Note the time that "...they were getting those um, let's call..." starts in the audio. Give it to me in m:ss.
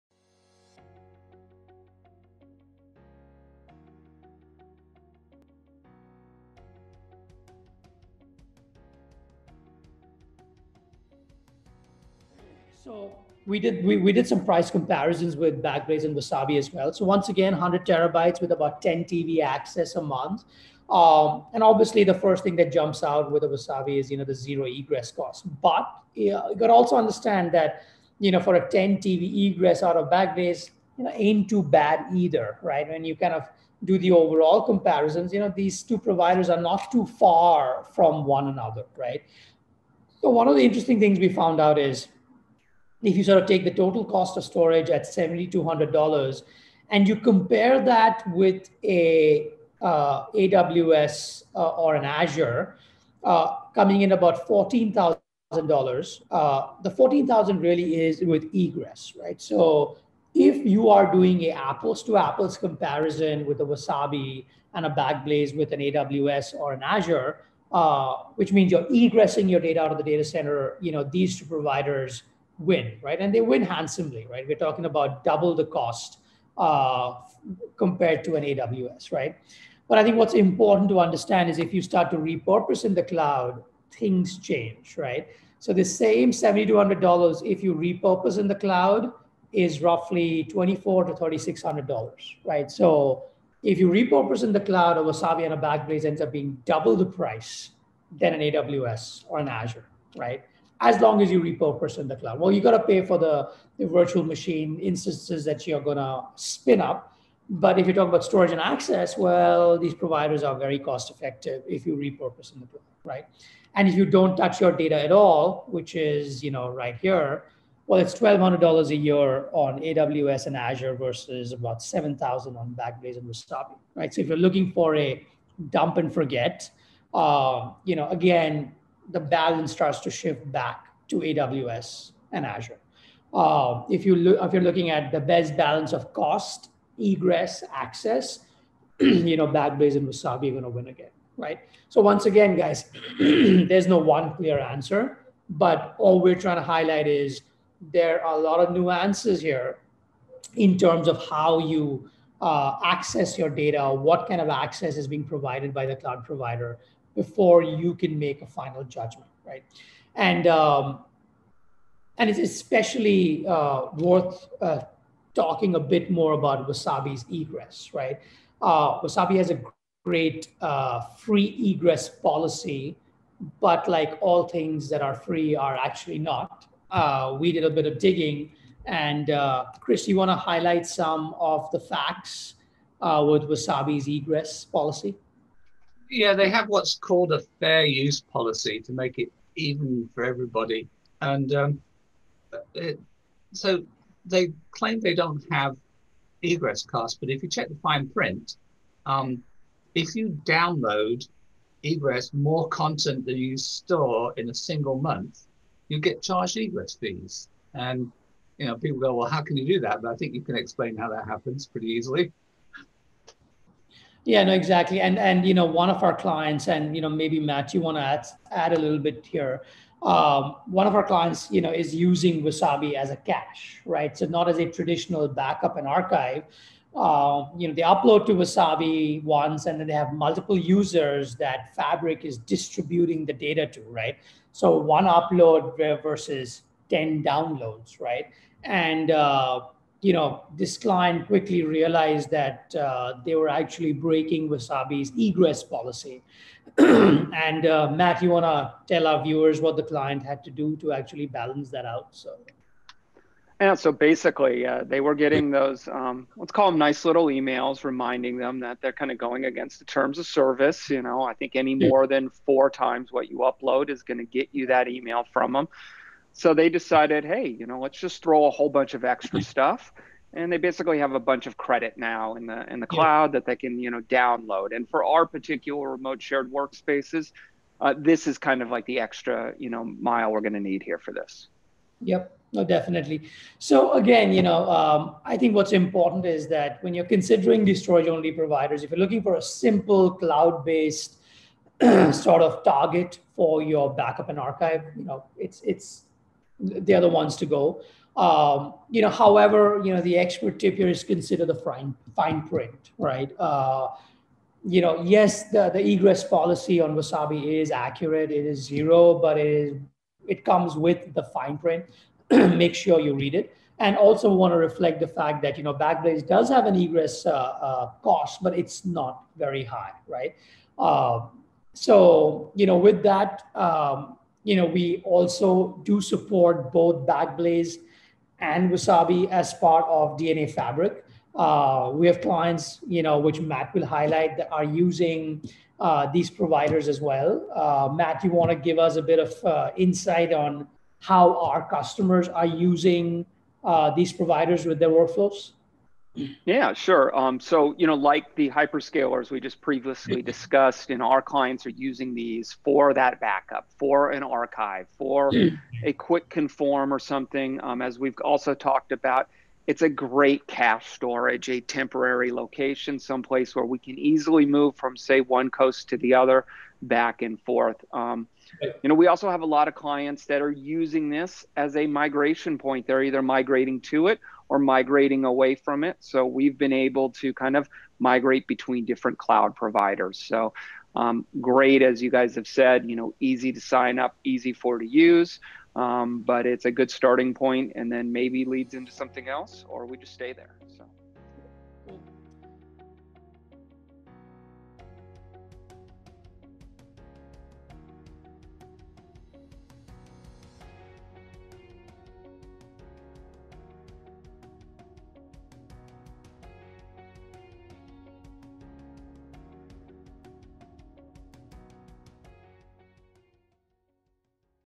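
4:14.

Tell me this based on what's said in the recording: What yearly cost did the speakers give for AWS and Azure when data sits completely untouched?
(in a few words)
$1,200.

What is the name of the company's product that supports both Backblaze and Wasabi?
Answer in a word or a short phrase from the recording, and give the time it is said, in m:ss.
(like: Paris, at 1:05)
DNAfabric, at 5:30.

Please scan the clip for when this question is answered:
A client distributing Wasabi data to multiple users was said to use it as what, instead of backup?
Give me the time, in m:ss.
3:43.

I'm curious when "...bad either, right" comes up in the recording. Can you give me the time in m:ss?
0:31.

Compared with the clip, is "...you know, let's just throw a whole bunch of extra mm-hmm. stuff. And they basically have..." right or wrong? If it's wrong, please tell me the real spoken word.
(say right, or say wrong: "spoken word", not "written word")
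right.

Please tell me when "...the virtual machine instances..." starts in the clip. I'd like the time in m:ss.
1:43.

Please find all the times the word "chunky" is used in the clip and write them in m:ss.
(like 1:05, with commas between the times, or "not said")
not said.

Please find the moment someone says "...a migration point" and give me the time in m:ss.
6:11.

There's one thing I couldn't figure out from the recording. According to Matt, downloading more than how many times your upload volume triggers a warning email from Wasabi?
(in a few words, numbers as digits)
four times.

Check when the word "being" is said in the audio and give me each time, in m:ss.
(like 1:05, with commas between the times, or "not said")
1:36, 2:35.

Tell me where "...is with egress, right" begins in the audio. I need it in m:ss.
0:58.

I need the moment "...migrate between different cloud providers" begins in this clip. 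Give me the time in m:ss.
6:17.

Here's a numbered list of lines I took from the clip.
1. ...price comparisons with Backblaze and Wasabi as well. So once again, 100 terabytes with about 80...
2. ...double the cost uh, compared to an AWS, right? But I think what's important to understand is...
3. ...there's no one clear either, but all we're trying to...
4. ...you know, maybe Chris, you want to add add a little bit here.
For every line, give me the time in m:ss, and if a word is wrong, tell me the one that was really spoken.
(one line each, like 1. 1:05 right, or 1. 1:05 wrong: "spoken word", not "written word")
1. 0:14 wrong: "10", not "80"
2. 1:15 right
3. 2:23 wrong: "answer", not "either"
4. 3:36 wrong: "Matt", not "Chris".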